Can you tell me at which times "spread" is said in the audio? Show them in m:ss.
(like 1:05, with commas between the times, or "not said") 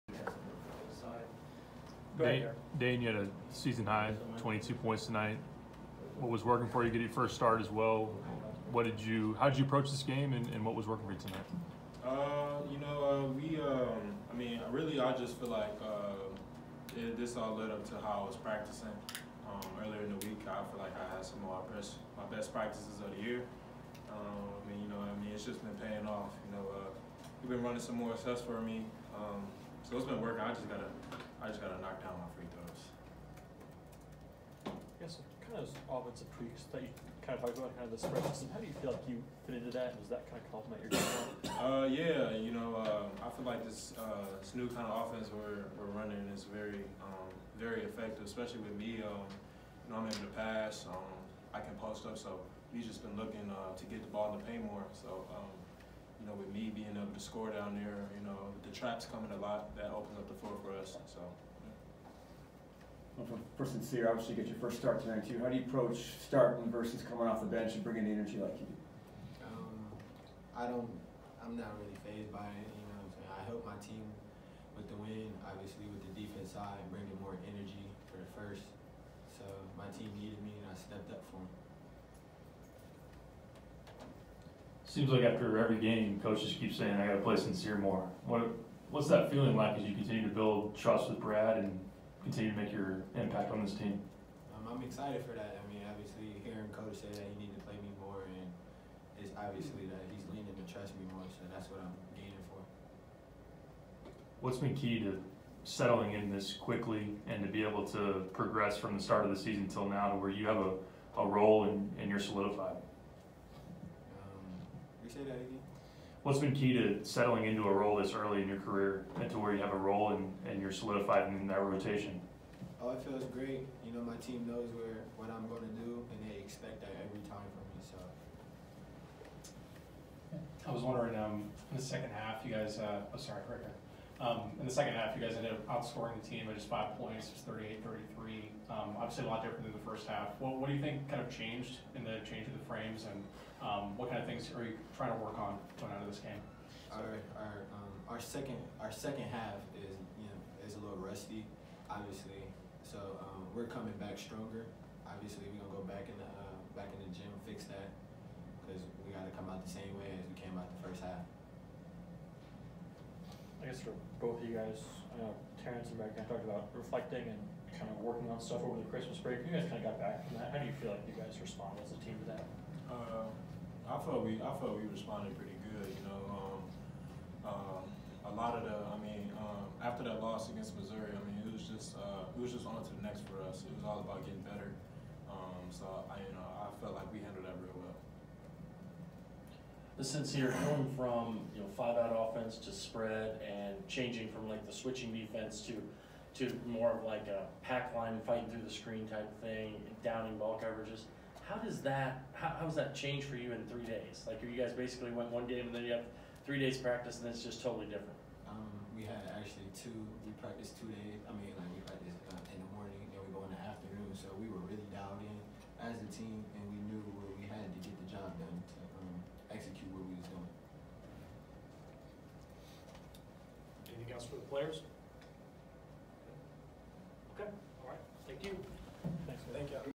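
0:37, 3:12.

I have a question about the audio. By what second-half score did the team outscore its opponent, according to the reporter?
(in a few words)
38-33.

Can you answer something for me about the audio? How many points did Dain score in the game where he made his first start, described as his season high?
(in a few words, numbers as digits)
22.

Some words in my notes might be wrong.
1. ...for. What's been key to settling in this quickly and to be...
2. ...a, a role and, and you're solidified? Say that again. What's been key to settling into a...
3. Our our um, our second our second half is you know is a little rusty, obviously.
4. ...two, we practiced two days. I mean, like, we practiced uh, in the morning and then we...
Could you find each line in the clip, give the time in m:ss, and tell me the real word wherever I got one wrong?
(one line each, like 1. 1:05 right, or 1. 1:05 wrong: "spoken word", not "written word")
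1. 1:42 right
2. 1:50 right
3. 2:26 right
4. 3:29 right.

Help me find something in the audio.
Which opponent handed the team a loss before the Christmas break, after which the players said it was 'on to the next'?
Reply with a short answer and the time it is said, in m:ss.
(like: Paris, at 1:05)
Missouri, at 3:00.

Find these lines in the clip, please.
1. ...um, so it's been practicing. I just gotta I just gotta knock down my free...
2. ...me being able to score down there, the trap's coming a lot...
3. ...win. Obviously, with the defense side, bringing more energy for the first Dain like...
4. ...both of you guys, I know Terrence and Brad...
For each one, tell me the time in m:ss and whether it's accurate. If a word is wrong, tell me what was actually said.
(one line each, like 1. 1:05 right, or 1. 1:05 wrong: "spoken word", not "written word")
1. 0:29 wrong: "working", not "practicing"
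2. 0:56 right
3. 1:15 wrong: "Seems", not "Dain"
4. 2:44 right.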